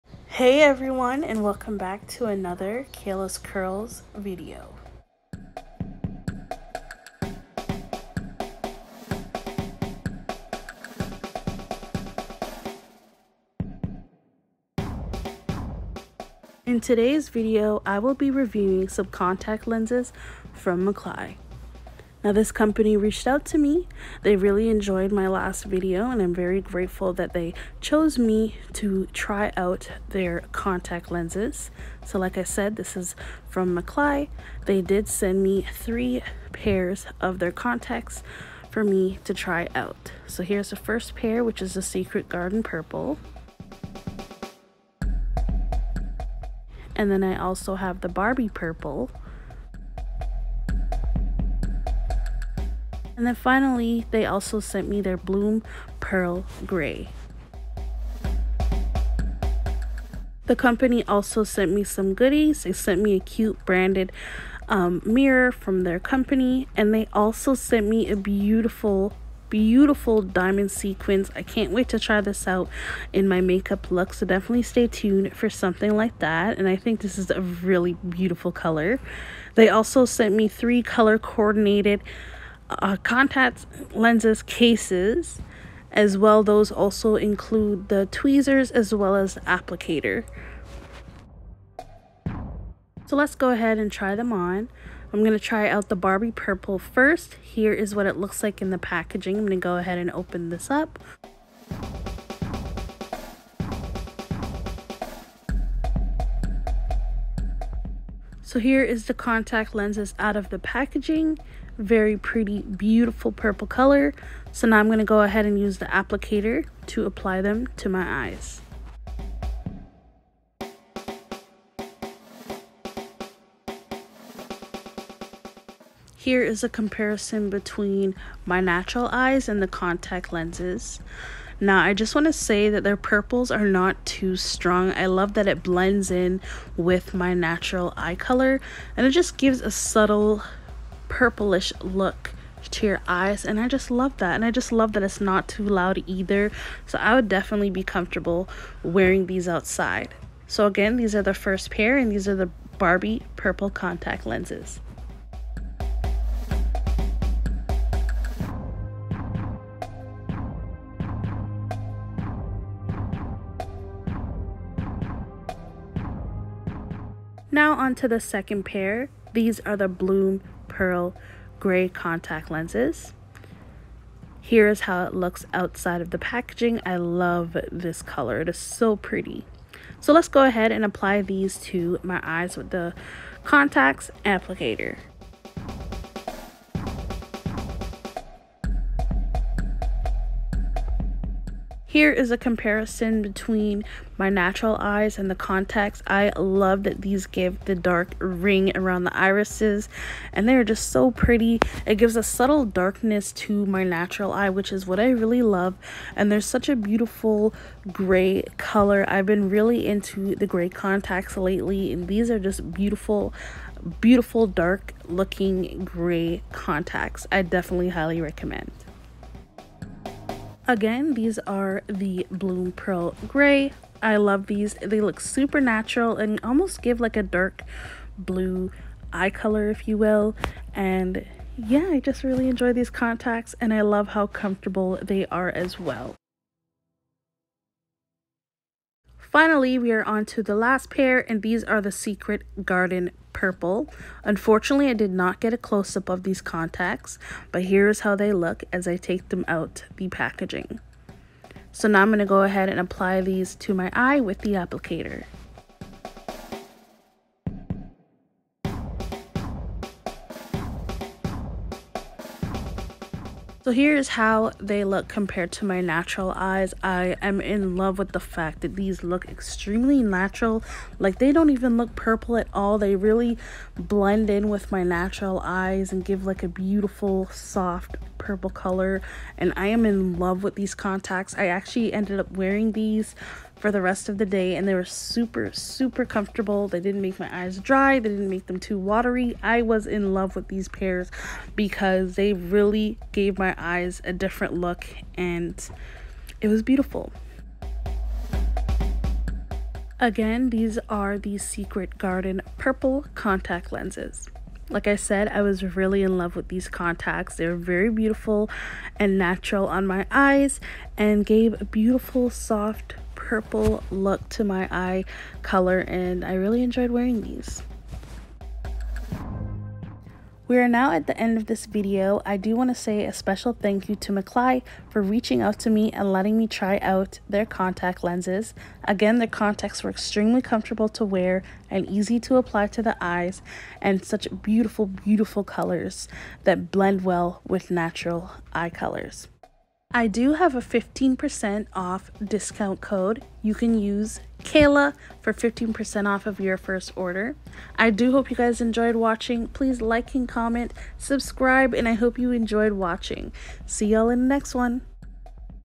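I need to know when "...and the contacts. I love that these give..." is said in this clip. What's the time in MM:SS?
03:15.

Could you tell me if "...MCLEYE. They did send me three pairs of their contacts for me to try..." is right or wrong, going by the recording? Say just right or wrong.
right.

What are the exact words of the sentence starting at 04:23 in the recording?
So here's how they look compared to my natural eyes.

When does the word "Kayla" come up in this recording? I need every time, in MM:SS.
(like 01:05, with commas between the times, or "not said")
00:02, 05:44.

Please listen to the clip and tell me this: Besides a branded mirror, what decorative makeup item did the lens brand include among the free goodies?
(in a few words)
Diamond sequins.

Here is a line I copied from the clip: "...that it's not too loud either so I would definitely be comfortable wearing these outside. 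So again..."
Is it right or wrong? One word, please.
right.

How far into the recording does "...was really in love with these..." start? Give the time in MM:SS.
05:05.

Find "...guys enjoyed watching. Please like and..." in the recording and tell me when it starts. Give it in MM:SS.
05:48.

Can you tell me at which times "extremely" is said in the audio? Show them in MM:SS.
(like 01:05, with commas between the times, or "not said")
04:29, 05:29.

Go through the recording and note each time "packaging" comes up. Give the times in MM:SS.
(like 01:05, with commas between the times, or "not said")
01:38, 01:50, 02:56, 04:10.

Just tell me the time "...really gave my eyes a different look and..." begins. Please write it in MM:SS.
04:52.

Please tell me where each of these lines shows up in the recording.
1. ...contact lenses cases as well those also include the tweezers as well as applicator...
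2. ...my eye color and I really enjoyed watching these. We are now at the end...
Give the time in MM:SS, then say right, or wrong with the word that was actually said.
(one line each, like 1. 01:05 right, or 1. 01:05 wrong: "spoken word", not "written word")
1. 01:23 right
2. 05:14 wrong: "wearing", not "watching".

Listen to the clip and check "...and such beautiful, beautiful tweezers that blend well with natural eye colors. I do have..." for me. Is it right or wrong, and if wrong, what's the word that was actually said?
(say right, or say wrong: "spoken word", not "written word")
wrong: "colors", not "tweezers".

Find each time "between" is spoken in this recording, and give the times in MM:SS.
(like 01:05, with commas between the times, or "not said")
02:07, 03:13.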